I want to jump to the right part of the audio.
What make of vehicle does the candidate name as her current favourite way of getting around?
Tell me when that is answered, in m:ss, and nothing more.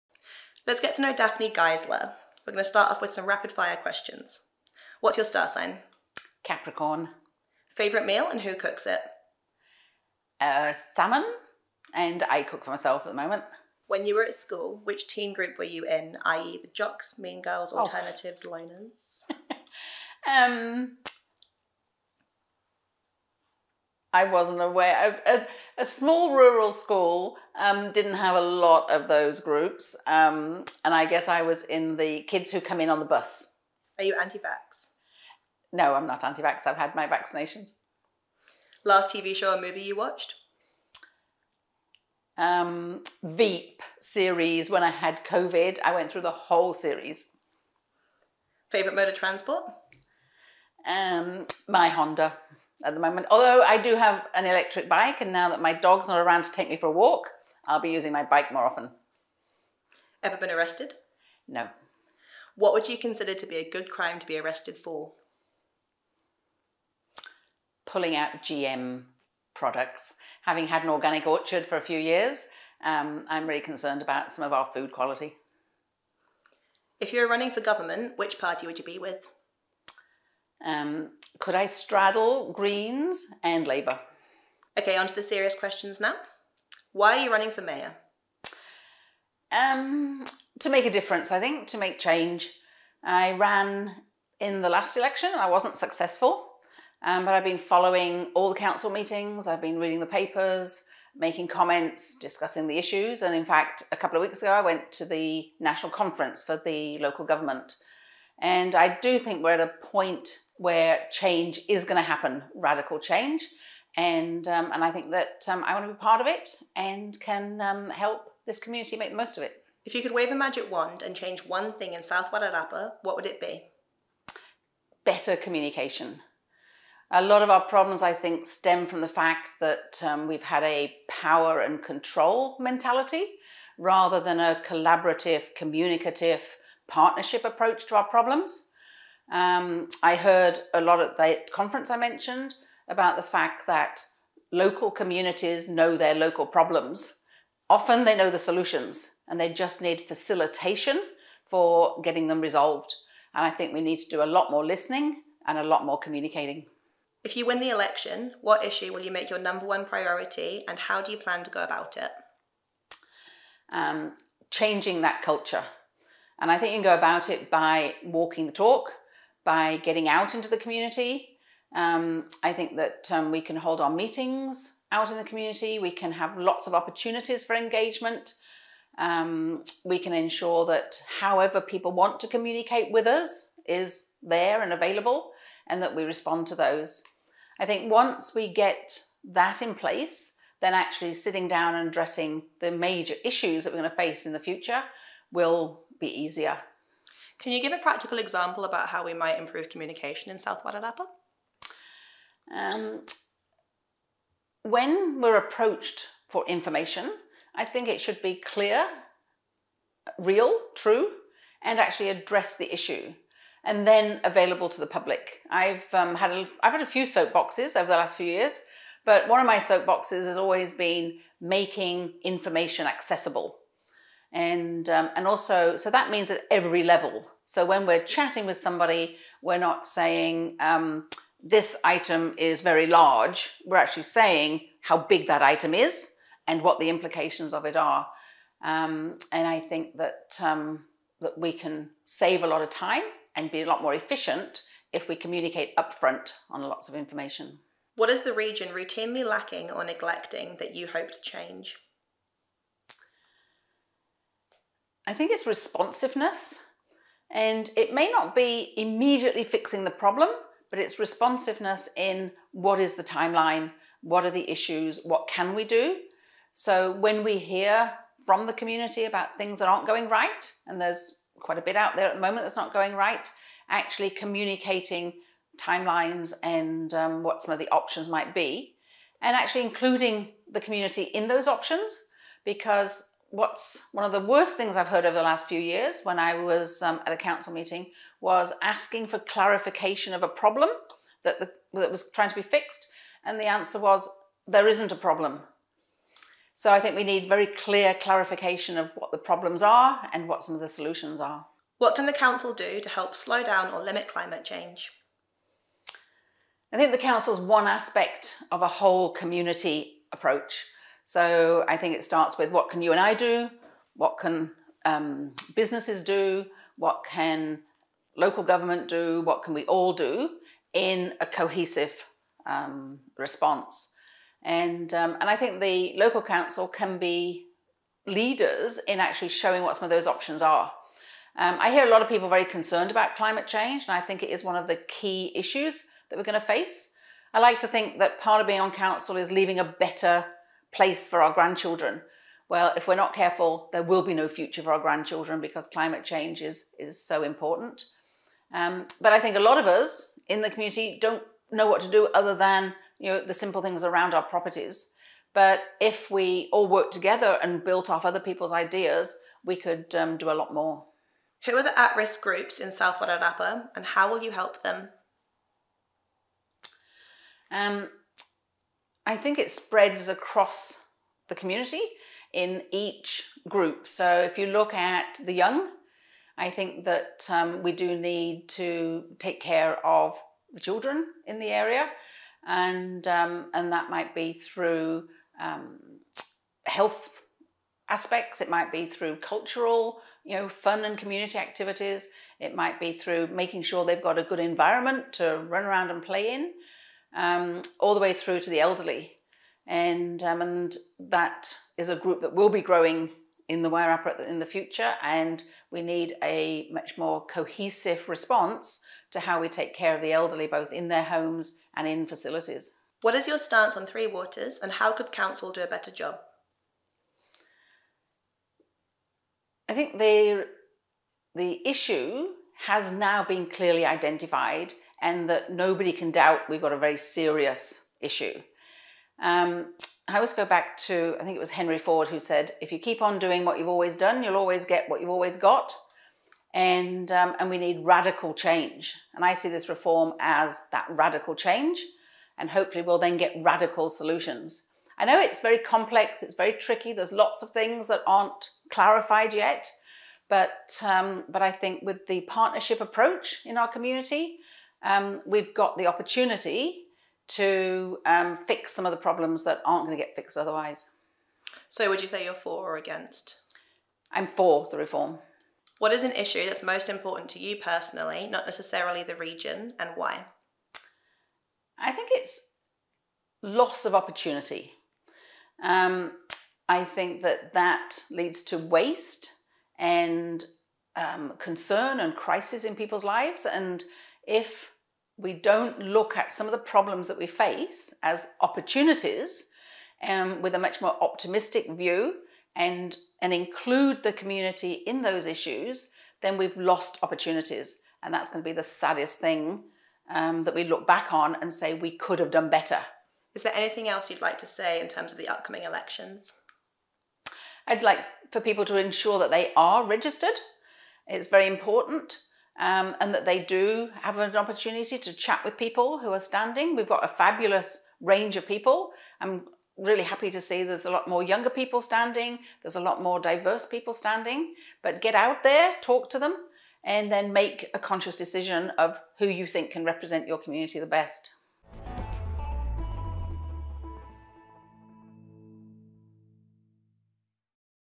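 0:51.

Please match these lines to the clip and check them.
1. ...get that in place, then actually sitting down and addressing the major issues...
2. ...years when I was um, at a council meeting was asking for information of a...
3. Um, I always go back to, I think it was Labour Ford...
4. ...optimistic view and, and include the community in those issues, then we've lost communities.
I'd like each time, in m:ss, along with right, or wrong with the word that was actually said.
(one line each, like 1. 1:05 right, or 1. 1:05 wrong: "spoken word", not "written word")
1. 3:08 right
2. 4:45 wrong: "clarification", not "information"
3. 7:09 wrong: "Henry", not "Labour"
4. 8:11 wrong: "opportunities", not "communities".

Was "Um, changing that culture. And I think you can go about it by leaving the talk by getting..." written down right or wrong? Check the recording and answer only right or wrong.
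wrong.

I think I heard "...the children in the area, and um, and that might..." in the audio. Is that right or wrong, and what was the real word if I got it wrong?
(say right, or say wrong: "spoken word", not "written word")
right.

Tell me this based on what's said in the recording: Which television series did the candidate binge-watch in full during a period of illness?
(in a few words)
Veep.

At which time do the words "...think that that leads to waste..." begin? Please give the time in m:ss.
7:56.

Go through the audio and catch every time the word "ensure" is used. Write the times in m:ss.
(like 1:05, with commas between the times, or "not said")
3:00, 8:28.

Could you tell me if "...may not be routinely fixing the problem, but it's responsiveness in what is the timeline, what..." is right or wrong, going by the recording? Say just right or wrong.
wrong.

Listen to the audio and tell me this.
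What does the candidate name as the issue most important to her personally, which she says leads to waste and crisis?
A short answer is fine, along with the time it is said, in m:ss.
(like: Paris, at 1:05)
Loss of opportunity, at 7:53.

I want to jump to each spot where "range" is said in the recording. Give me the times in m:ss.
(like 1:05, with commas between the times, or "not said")
8:38.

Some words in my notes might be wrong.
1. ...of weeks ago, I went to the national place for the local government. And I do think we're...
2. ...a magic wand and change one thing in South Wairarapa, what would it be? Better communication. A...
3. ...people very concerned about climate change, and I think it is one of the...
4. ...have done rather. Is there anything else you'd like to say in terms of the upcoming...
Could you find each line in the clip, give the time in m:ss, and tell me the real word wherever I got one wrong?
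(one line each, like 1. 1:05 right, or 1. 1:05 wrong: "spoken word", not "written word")
1. 1:44 wrong: "conference", not "place"
2. 2:00 right
3. 5:32 right
4. 8:22 wrong: "better", not "rather".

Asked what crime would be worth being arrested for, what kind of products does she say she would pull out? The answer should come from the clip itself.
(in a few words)
GM products.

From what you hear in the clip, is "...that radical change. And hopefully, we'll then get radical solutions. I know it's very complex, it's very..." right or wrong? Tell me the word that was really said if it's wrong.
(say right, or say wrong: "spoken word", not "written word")
right.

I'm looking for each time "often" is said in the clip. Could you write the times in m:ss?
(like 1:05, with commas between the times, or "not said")
0:58, 2:27.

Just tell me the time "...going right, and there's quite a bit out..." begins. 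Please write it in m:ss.
4:29.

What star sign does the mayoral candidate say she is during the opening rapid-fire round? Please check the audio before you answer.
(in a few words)
Capricorn.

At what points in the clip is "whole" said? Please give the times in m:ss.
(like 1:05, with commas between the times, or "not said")
0:46, 5:08.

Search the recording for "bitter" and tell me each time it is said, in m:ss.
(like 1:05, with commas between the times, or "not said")
not said.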